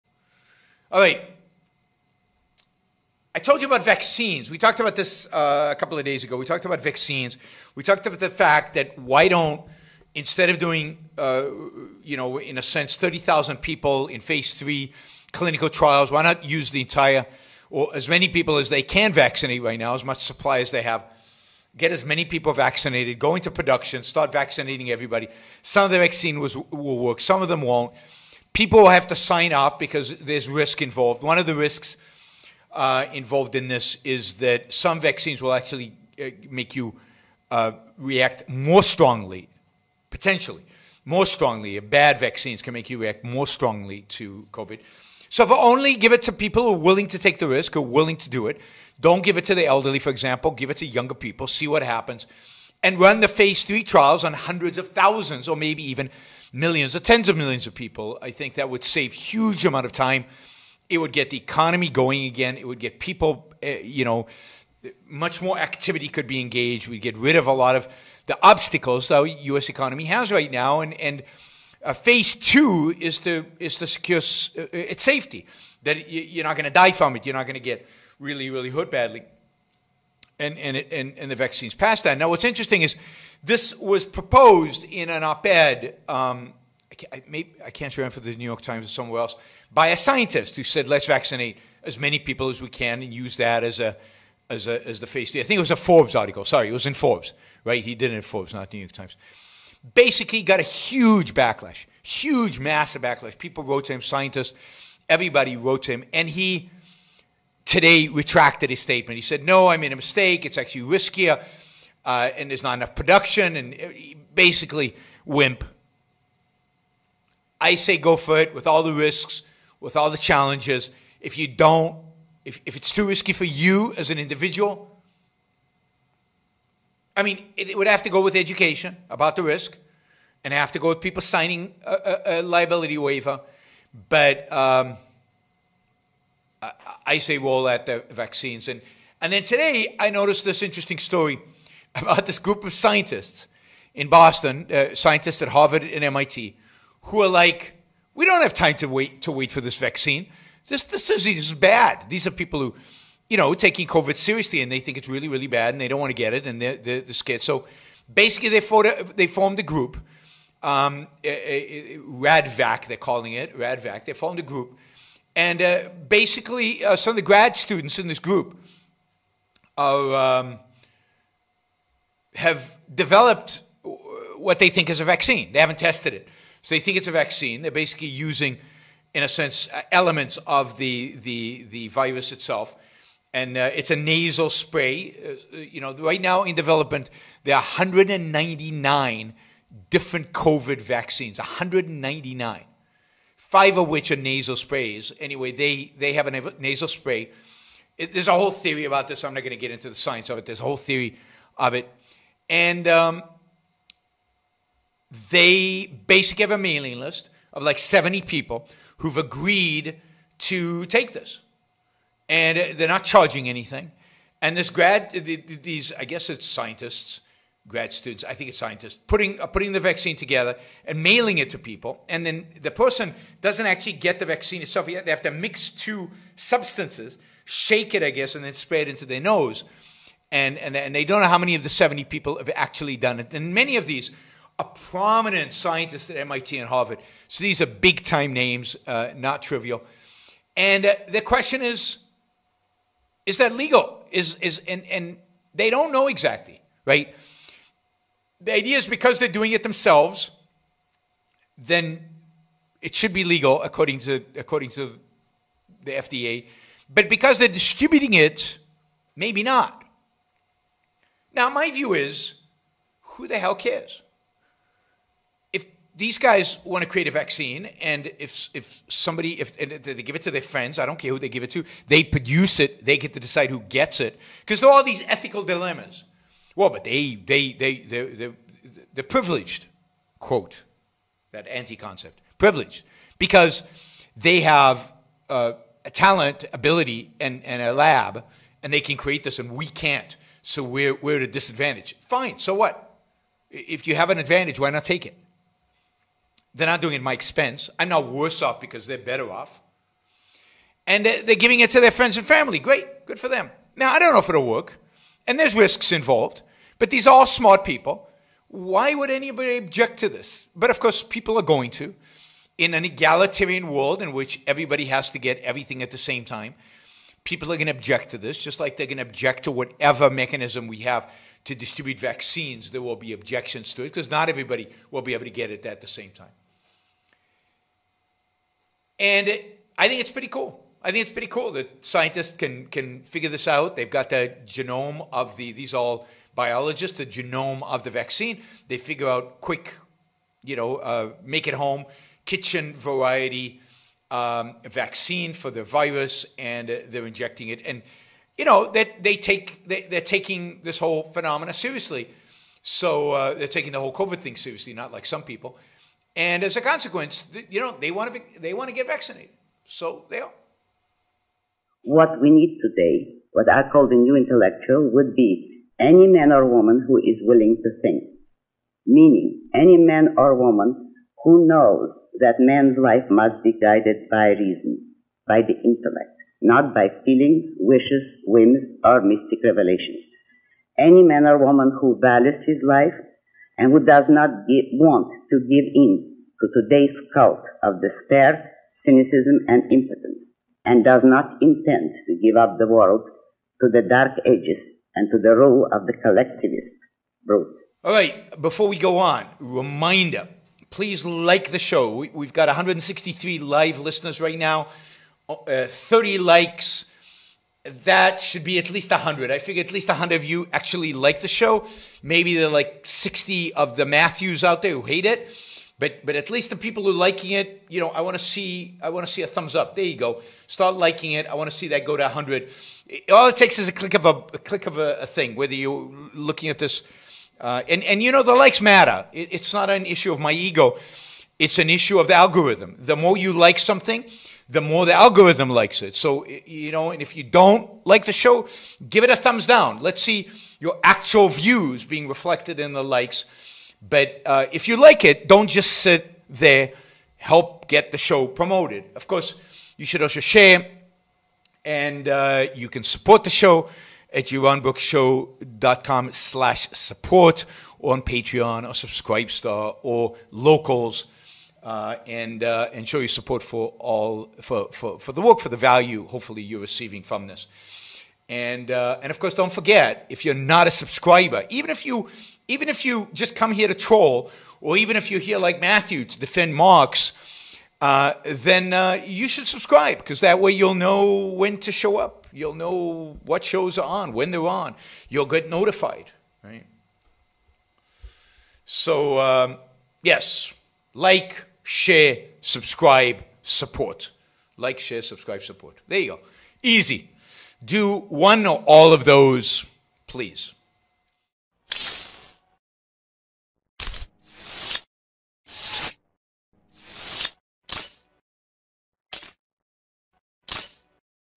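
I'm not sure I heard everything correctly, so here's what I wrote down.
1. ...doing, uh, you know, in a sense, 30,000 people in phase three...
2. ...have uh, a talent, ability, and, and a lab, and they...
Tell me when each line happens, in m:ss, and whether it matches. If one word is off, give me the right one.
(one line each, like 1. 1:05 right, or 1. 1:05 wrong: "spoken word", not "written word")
1. 0:10 right
2. 4:44 right.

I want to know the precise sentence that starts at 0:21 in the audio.
Get as many people vaccinated, go into production, start vaccinating everybody.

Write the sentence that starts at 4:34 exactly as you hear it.
Because there are all these ethical dilemmas.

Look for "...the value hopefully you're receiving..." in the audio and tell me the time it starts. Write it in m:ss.
7:45.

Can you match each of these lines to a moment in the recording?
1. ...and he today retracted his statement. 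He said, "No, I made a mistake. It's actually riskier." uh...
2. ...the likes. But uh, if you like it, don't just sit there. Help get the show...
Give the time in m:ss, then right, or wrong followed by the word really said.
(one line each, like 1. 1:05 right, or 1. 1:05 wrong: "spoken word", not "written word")
1. 1:46 right
2. 7:22 right.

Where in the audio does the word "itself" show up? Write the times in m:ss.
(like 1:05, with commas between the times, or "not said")
3:02, 3:44.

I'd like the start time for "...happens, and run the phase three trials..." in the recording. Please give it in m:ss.
0:51.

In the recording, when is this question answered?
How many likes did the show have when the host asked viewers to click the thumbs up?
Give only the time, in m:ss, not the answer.
6:45.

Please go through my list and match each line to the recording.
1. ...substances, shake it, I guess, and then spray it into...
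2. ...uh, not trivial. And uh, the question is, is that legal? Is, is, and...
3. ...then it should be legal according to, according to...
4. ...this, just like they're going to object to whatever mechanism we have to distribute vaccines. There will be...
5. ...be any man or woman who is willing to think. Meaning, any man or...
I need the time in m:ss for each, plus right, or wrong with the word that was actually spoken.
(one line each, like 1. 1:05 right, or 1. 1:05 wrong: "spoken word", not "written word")
1. 3:46 right
2. 3:58 right
3. 4:11 right
4. 5:18 right
5. 6:05 right.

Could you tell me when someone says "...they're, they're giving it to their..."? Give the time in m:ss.
5:01.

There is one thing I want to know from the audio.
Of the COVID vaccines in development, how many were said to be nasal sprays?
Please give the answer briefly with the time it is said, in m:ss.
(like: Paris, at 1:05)
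5, at 3:13.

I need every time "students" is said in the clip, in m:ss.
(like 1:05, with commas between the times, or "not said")
2:47, 3:37.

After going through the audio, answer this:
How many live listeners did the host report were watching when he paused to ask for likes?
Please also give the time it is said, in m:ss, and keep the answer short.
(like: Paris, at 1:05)
163, at 6:42.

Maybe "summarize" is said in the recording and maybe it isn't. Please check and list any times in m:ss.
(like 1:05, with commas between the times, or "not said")
not said.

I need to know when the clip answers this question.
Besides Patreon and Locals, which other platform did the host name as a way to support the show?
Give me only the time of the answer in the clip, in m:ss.
7:38.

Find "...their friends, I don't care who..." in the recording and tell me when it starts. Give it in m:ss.
4:30.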